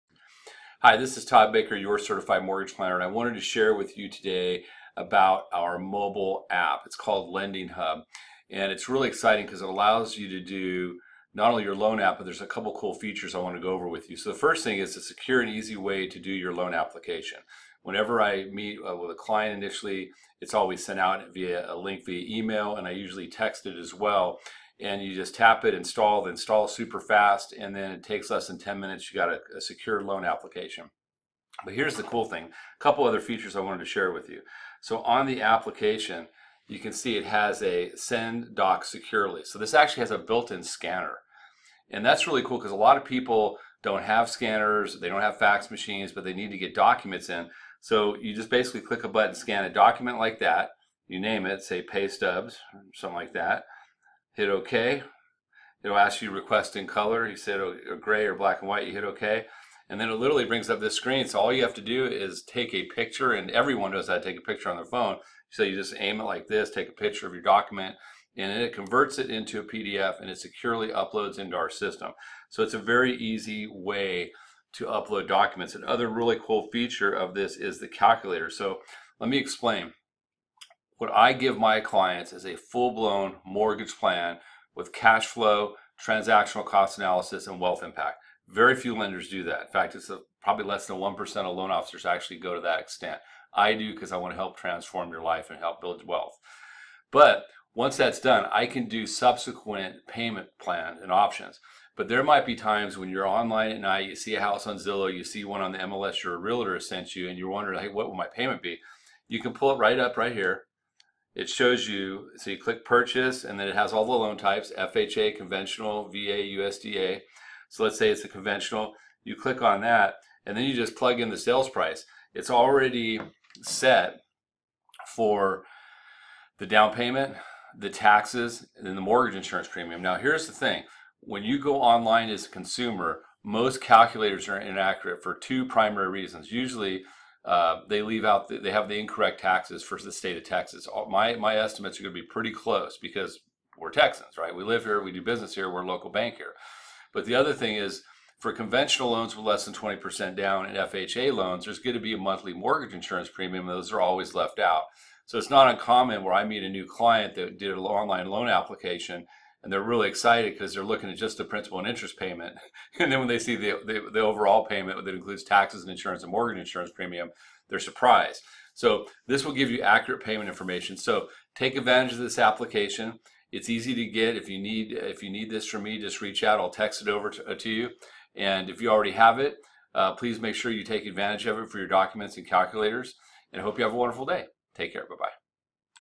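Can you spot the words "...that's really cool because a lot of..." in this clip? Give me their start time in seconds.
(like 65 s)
42 s.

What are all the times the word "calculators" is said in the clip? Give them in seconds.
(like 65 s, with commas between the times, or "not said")
77 s, 133 s, 182 s.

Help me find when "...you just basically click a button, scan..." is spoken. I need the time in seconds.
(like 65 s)
48 s.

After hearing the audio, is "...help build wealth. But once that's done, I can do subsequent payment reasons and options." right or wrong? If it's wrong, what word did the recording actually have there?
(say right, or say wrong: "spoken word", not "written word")
wrong: "plans", not "reasons".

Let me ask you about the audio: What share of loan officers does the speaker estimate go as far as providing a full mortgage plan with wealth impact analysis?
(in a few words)
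less than 1%.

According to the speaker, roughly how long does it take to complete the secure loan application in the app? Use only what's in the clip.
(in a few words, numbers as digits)
less than 10 minutes.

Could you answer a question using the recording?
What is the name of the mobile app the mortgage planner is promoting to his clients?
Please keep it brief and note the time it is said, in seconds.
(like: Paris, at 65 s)
Lending Hub, at 7 s.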